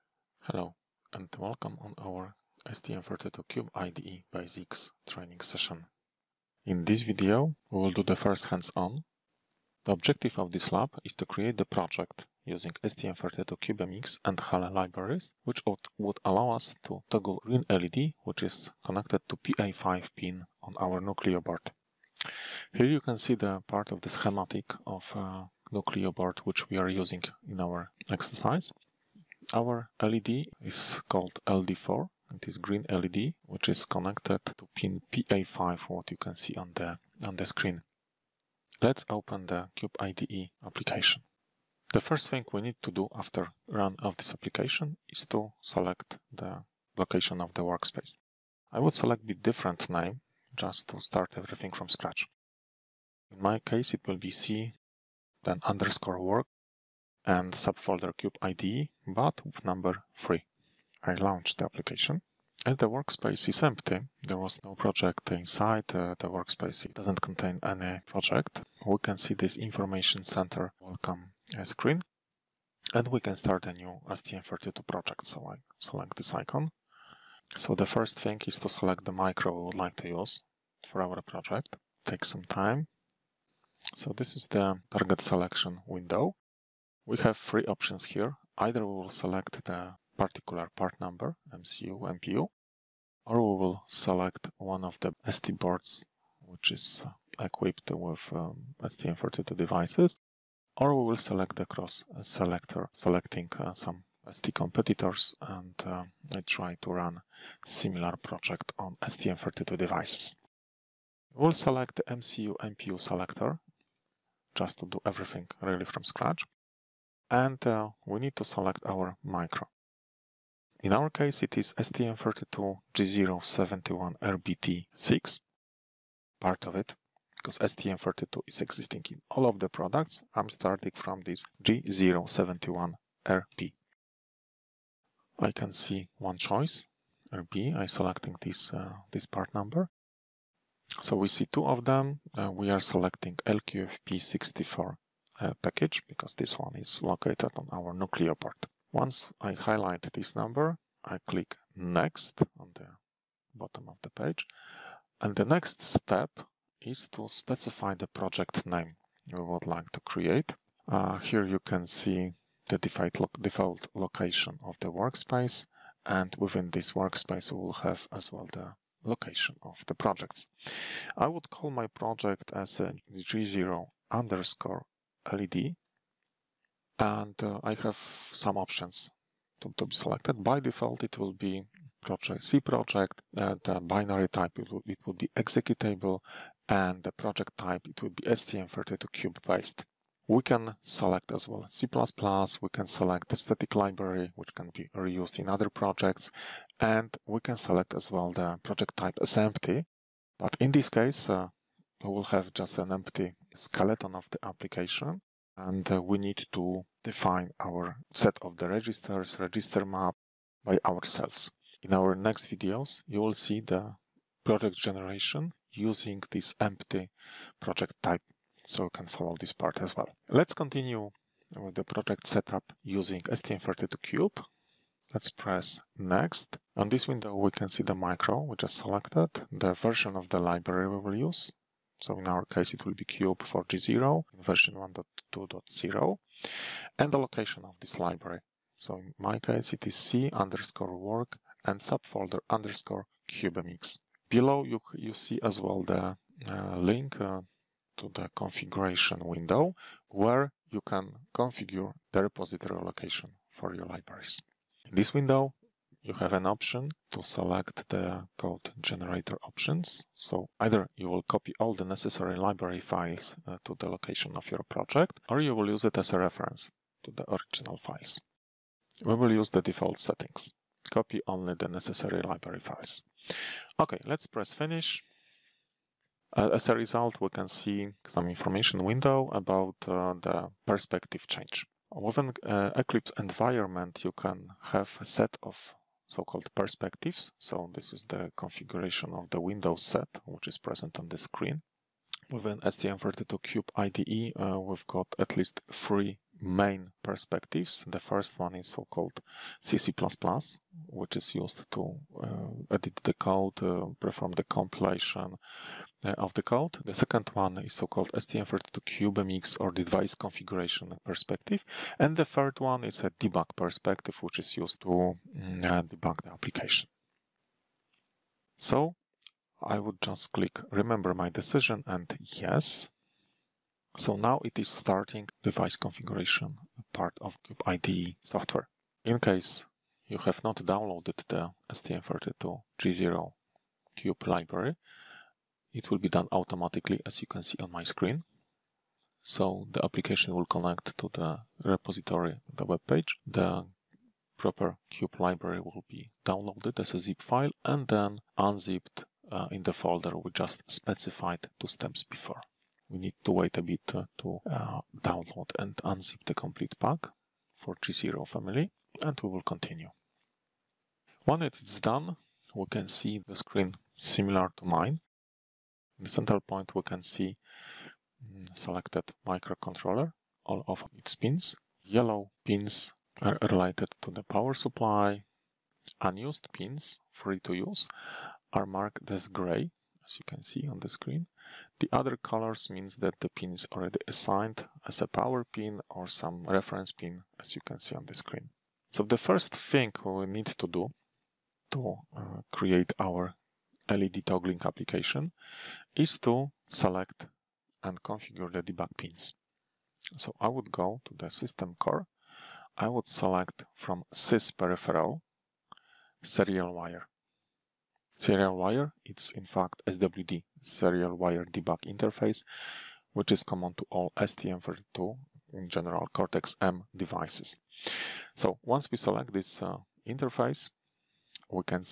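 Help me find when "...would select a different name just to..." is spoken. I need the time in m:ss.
0:48.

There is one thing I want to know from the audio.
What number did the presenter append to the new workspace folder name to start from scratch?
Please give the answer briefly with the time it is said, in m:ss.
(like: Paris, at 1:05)
3, at 0:59.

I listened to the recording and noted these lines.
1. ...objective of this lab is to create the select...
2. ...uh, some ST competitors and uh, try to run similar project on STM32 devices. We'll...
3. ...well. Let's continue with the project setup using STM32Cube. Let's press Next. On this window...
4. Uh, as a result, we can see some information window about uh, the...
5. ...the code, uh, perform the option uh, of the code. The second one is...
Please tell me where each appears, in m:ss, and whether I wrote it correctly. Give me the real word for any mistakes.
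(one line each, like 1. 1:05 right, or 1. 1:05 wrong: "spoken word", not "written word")
1. 0:09 wrong: "project", not "select"
2. 1:43 right
3. 3:39 right
4. 4:36 right
5. 5:03 wrong: "compilation", not "option".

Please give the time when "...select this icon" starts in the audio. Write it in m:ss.
1:15.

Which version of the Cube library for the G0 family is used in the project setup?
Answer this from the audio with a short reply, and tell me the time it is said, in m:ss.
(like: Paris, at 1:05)
1.2.0, at 3:54.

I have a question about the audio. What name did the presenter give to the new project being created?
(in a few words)
g0_LED.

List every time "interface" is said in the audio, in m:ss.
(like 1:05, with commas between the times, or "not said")
6:51, 7:00.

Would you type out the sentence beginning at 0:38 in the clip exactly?
Let's open the Cube IDE application.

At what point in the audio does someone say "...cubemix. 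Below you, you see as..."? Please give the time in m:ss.
4:03.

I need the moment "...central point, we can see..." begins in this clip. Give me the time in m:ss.
6:06.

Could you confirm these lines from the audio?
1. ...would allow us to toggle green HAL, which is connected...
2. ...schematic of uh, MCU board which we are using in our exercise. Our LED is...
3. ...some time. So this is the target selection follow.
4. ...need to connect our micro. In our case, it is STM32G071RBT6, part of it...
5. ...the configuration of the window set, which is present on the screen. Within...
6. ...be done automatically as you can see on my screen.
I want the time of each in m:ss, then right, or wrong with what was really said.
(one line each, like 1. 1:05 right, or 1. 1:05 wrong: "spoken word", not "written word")
1. 0:15 wrong: "LED", not "HAL"
2. 0:24 wrong: "Nucleo", not "MCU"
3. 1:22 wrong: "window", not "follow"
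4. 1:58 wrong: "select", not "connect"
5. 4:48 right
6. 5:35 right.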